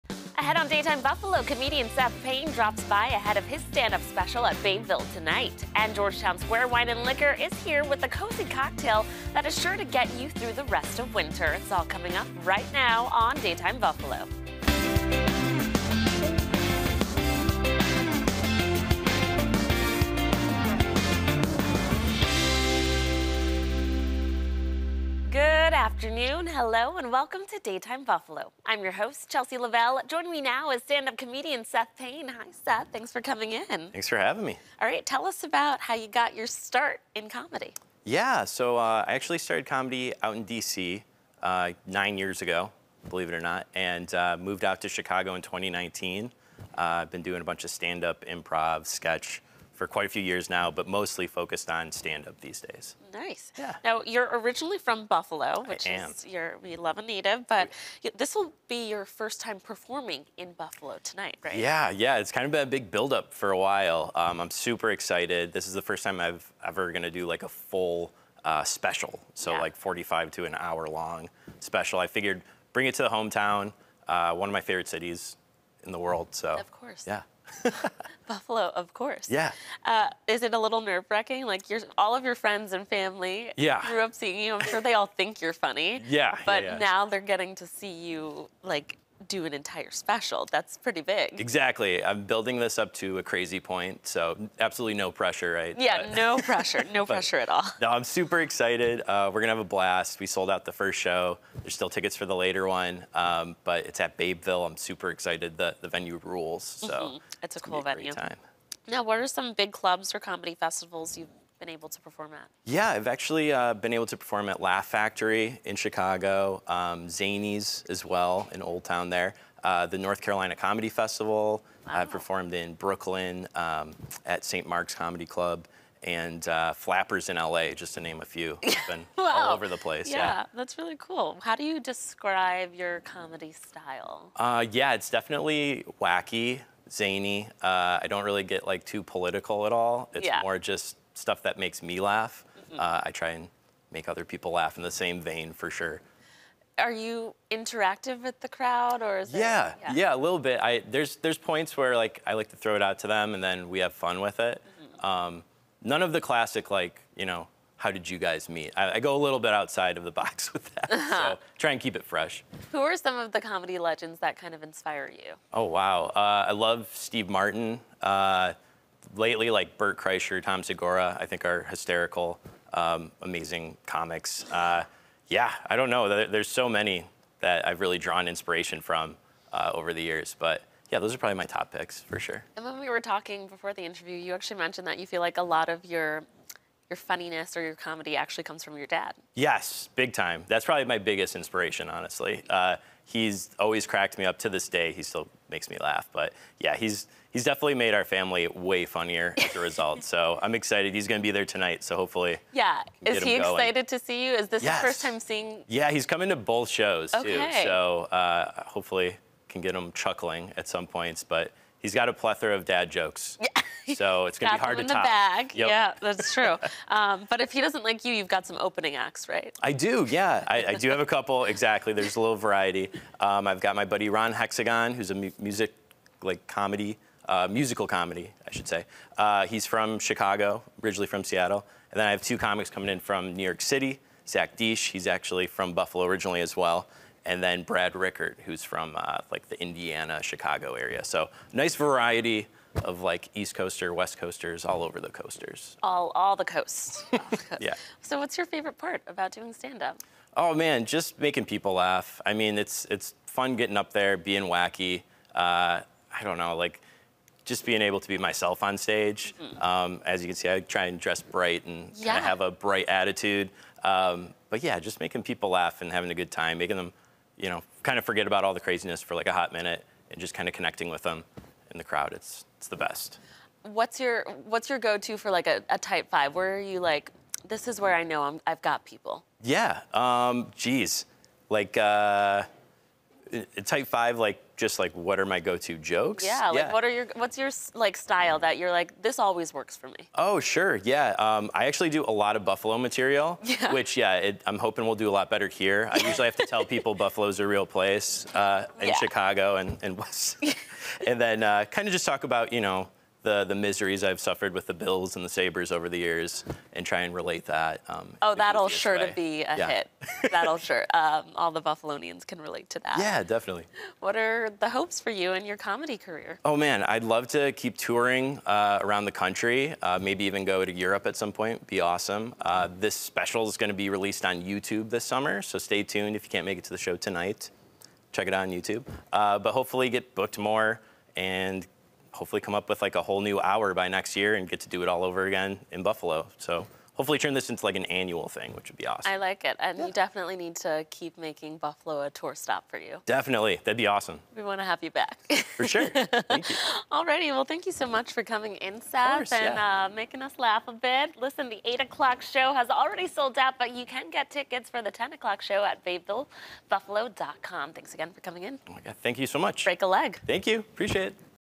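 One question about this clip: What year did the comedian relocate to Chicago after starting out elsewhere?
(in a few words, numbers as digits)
2019.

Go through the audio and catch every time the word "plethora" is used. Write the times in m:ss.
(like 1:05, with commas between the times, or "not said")
3:32.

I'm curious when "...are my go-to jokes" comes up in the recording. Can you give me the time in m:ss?
4:45.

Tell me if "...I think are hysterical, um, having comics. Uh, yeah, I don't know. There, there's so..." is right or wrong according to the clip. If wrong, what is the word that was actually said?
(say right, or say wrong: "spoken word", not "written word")
wrong: "amazing", not "having".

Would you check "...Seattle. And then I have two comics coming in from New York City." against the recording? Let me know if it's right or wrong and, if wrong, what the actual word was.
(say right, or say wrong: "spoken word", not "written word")
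right.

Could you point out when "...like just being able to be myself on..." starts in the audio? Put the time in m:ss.
4:16.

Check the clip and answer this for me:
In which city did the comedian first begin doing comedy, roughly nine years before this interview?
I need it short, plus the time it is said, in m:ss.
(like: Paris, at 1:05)
D.C., at 0:40.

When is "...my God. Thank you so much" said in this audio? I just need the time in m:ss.
5:58.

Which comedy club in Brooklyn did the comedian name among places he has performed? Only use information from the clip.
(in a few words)
St. Mark's Comedy Club.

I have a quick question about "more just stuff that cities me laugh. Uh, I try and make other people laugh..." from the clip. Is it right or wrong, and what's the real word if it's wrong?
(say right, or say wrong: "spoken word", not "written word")
wrong: "makes", not "cities".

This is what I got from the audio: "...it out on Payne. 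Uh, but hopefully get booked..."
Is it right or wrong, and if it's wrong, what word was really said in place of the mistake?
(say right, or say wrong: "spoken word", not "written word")
wrong: "YouTube", not "Payne".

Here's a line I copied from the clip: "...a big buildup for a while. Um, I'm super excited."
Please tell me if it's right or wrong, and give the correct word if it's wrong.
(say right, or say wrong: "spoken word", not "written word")
right.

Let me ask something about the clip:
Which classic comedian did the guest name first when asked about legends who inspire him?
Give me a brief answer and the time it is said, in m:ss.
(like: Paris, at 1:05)
Steve Martin, at 2:46.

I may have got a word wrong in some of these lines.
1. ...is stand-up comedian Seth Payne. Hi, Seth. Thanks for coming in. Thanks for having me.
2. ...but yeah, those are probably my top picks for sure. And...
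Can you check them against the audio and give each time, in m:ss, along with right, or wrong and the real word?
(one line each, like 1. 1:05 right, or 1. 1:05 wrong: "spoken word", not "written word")
1. 0:30 right
2. 3:00 right.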